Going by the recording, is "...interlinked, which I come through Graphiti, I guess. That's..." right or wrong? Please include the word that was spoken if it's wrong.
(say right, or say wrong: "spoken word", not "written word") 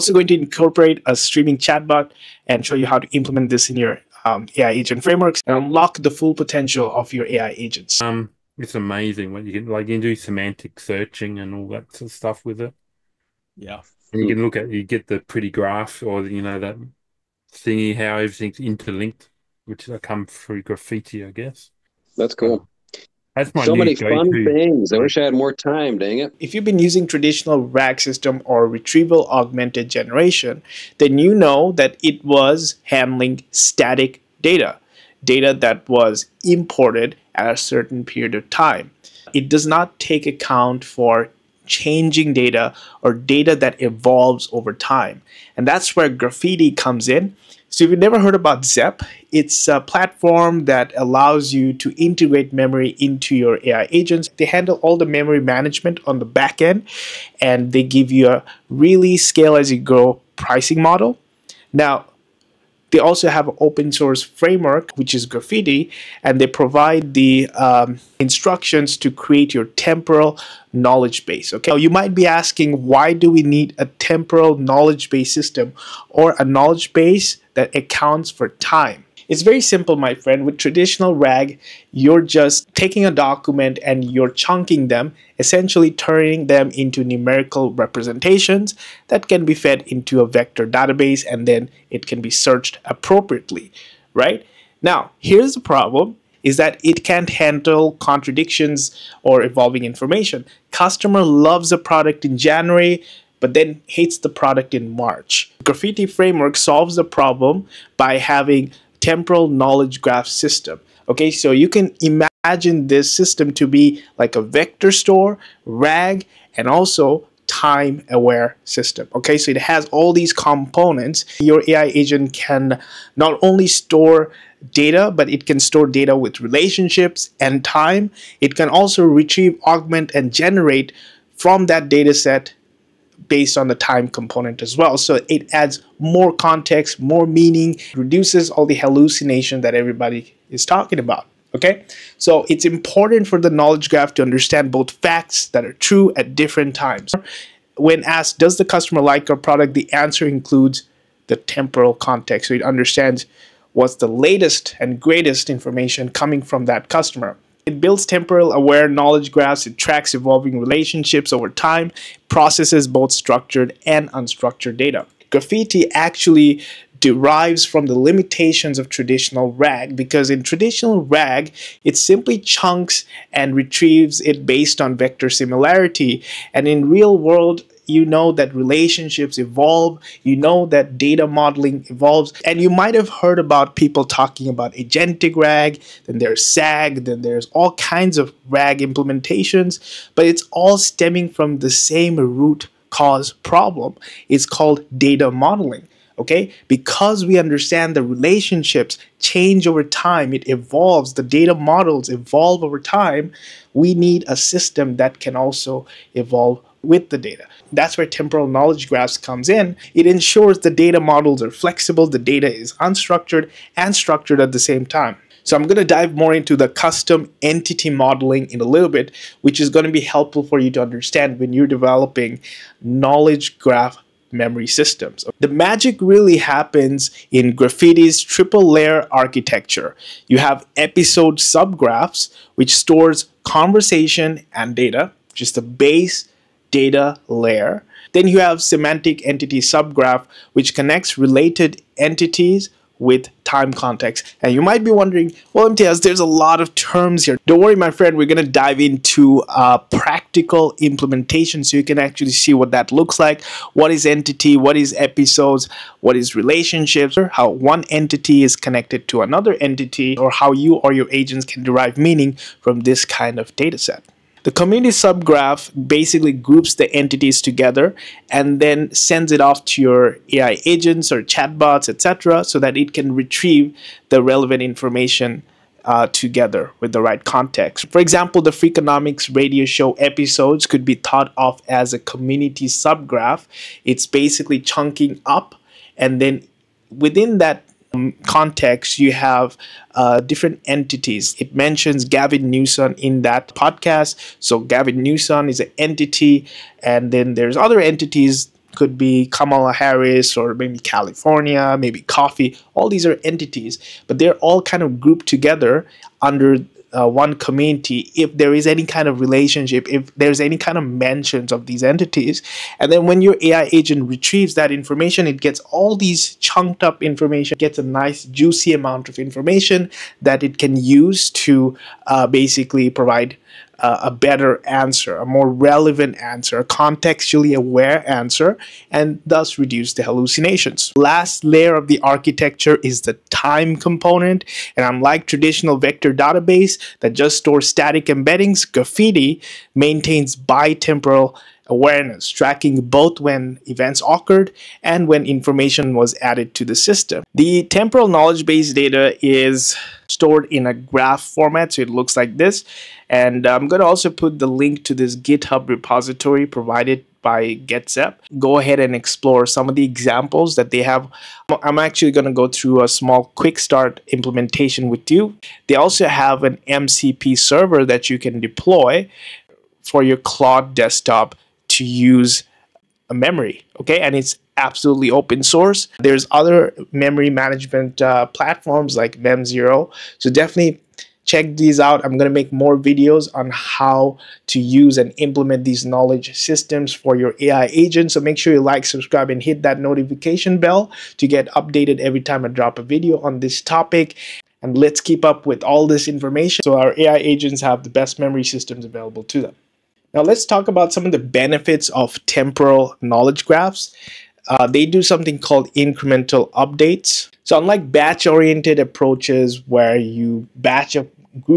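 right.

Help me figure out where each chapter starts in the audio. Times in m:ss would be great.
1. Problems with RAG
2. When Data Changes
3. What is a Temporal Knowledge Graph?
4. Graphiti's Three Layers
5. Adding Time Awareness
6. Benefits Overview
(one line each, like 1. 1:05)
1. 0:14
2. 1:19
3. 2:22
4. 3:46
5. 5:32
6. 6:40.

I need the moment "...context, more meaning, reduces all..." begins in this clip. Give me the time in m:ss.
2:16.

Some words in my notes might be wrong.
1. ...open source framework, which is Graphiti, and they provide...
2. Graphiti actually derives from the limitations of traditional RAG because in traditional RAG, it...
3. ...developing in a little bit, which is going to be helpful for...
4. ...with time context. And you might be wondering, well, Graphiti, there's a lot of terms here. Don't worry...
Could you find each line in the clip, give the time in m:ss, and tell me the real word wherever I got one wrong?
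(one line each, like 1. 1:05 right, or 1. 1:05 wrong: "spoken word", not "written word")
1. 1:03 right
2. 2:45 right
3. 3:37 wrong: "modeling", not "developing"
4. 4:02 wrong: "Imtiaz", not "Graphiti".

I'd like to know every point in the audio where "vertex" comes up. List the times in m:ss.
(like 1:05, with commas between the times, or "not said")
not said.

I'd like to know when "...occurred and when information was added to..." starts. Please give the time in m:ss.
5:44.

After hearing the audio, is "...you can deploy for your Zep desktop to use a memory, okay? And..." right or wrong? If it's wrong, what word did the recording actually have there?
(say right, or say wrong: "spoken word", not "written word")
wrong: "Claude", not "Zep".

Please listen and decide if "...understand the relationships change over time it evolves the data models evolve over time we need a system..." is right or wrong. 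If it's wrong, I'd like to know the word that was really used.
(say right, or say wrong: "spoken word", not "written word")
right.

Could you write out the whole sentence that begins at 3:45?
The magic really happens in Graphiti's triple layer architecture.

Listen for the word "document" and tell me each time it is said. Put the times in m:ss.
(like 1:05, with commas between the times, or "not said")
1:23.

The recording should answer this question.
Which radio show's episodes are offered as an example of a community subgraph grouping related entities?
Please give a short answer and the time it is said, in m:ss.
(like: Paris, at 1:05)
Freakonomics, at 4:38.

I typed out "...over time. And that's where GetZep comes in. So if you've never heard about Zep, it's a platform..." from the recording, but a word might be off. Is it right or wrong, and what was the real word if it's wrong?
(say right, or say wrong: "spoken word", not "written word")
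wrong: "Graphiti", not "GetZep".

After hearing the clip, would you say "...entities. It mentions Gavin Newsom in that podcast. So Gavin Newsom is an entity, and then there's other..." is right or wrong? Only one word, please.
right.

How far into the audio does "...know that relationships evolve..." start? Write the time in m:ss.
2:58.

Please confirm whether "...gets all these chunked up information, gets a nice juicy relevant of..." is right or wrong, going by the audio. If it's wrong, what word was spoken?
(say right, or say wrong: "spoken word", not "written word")
wrong: "amount", not "relevant".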